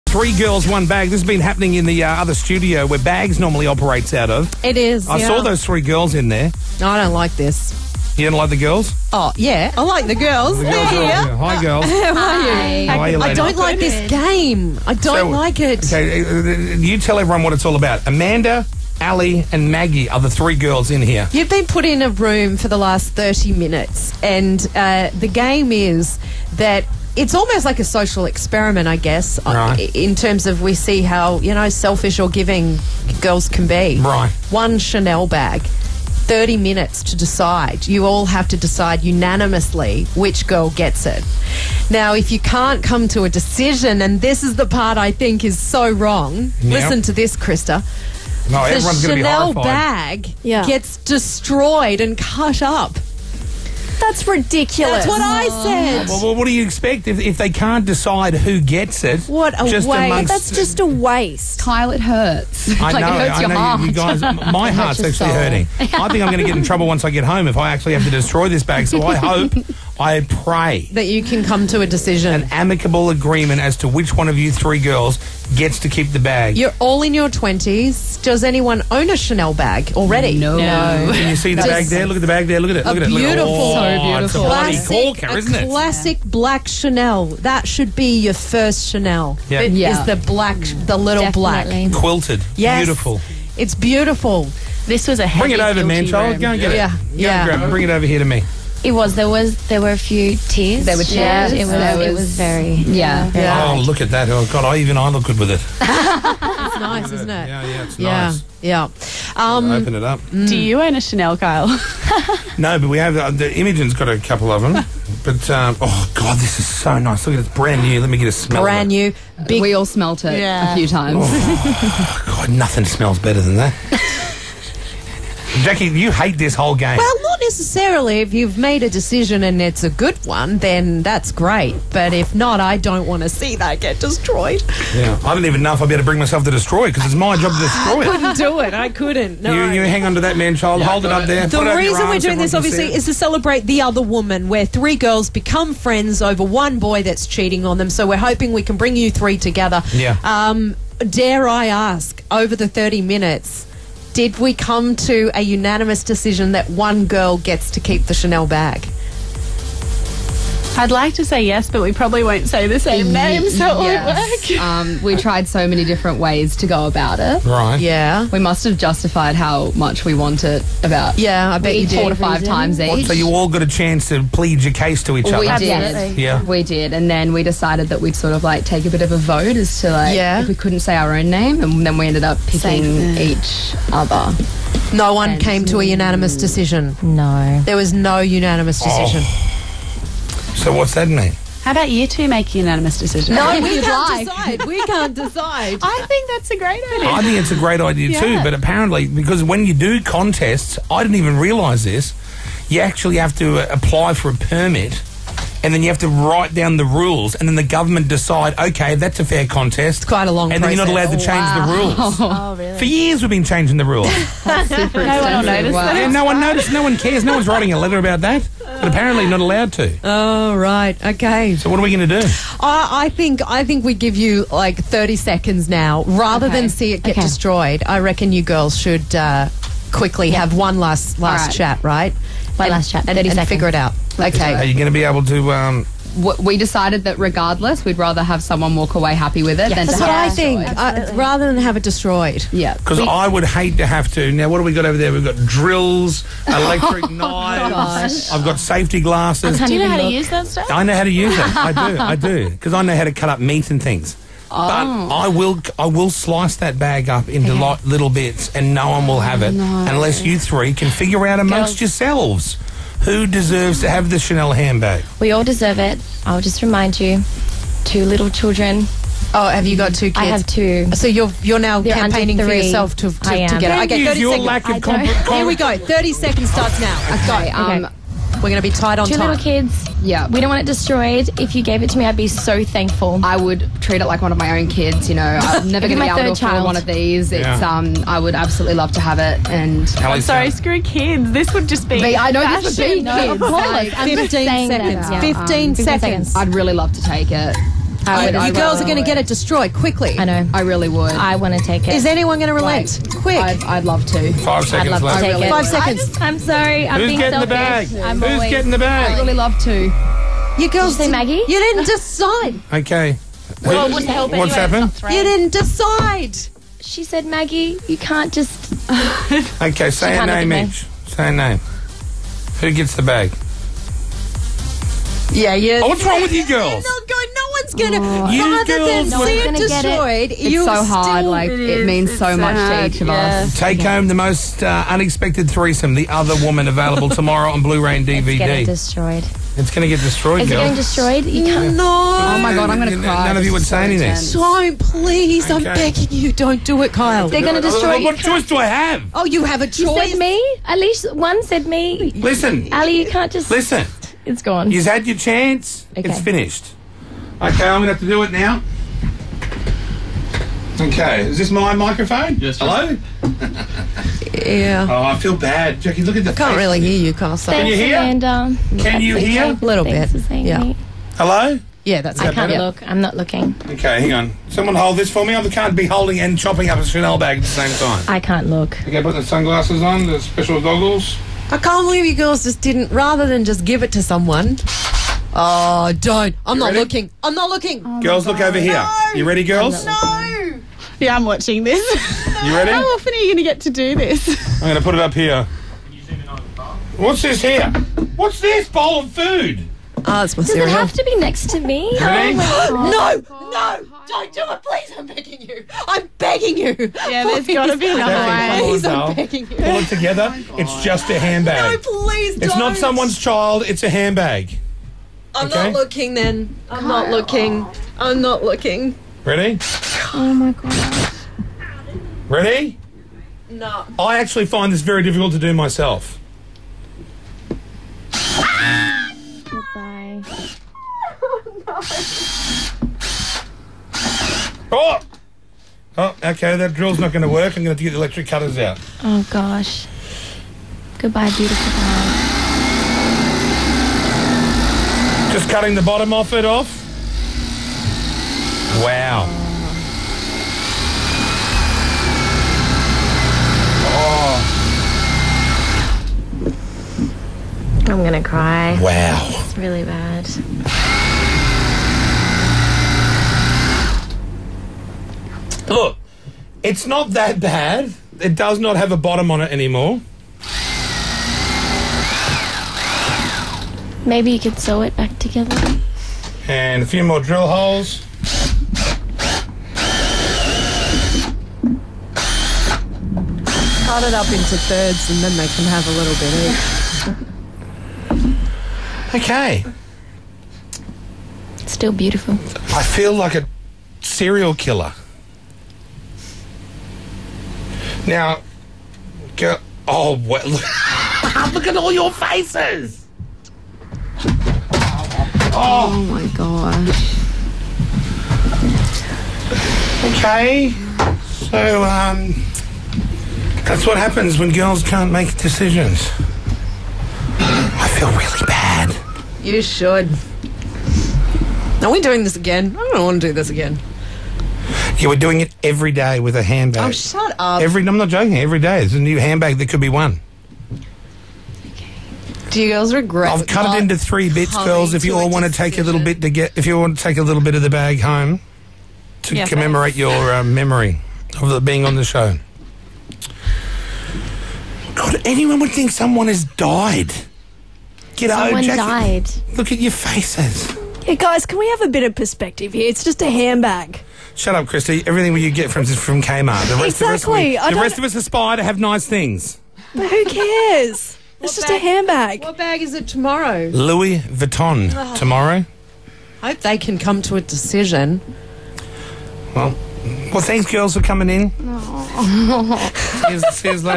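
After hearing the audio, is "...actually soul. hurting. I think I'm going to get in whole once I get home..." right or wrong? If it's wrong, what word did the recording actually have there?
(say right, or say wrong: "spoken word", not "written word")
wrong: "trouble", not "whole".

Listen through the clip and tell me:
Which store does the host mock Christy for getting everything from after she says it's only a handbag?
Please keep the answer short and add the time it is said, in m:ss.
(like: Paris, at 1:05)
Kmart, at 9:16.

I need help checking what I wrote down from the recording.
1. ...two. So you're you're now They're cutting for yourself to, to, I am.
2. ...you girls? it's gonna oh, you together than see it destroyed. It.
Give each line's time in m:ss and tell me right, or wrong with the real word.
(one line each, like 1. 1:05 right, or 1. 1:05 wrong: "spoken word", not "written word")
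1. 4:30 wrong: "campaigning", not "cutting"
2. 5:26 wrong: "rather", not "together".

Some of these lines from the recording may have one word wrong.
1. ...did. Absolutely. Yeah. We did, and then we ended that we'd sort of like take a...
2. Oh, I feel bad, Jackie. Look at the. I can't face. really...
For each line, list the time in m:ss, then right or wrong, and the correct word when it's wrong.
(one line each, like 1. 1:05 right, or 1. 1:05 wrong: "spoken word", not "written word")
1. 2:55 wrong: "decided", not "ended"
2. 6:04 right.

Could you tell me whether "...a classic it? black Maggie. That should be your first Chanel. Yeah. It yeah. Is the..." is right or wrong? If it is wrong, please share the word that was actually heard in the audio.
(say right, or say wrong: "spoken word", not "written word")
wrong: "Chanel", not "Maggie".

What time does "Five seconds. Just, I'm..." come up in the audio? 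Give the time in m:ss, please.
5:05.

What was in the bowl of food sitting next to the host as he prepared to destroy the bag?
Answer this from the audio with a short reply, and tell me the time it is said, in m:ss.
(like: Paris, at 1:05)
Cereal, at 6:40.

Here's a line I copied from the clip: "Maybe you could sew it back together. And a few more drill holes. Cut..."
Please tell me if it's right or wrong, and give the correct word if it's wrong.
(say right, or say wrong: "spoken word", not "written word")
right.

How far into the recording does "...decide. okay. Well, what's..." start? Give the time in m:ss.
5:11.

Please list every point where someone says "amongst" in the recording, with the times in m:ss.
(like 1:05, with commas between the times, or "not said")
1:00, 4:21.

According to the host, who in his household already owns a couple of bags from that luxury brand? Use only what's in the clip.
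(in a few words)
Imogen.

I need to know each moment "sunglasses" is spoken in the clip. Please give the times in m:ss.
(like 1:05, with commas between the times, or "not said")
6:19.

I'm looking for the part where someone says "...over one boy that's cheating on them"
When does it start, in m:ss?
2:26.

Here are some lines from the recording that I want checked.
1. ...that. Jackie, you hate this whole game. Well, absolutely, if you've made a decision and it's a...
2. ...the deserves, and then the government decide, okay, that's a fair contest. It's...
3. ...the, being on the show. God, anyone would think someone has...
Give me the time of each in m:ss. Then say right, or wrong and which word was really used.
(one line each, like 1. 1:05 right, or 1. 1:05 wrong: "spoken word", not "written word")
1. 2:03 wrong: "necessarily", not "absolutely"
2. 3:26 wrong: "rules", not "deserves"
3. 9:01 right.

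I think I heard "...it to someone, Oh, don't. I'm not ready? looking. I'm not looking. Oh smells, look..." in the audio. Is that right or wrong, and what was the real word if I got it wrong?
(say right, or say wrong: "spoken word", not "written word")
wrong: "girls", not "smells".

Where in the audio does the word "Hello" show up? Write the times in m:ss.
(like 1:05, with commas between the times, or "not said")
6:02, 6:11.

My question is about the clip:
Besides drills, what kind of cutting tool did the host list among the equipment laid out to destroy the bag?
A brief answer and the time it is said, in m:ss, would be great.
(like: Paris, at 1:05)
Electric knives, at 4:06.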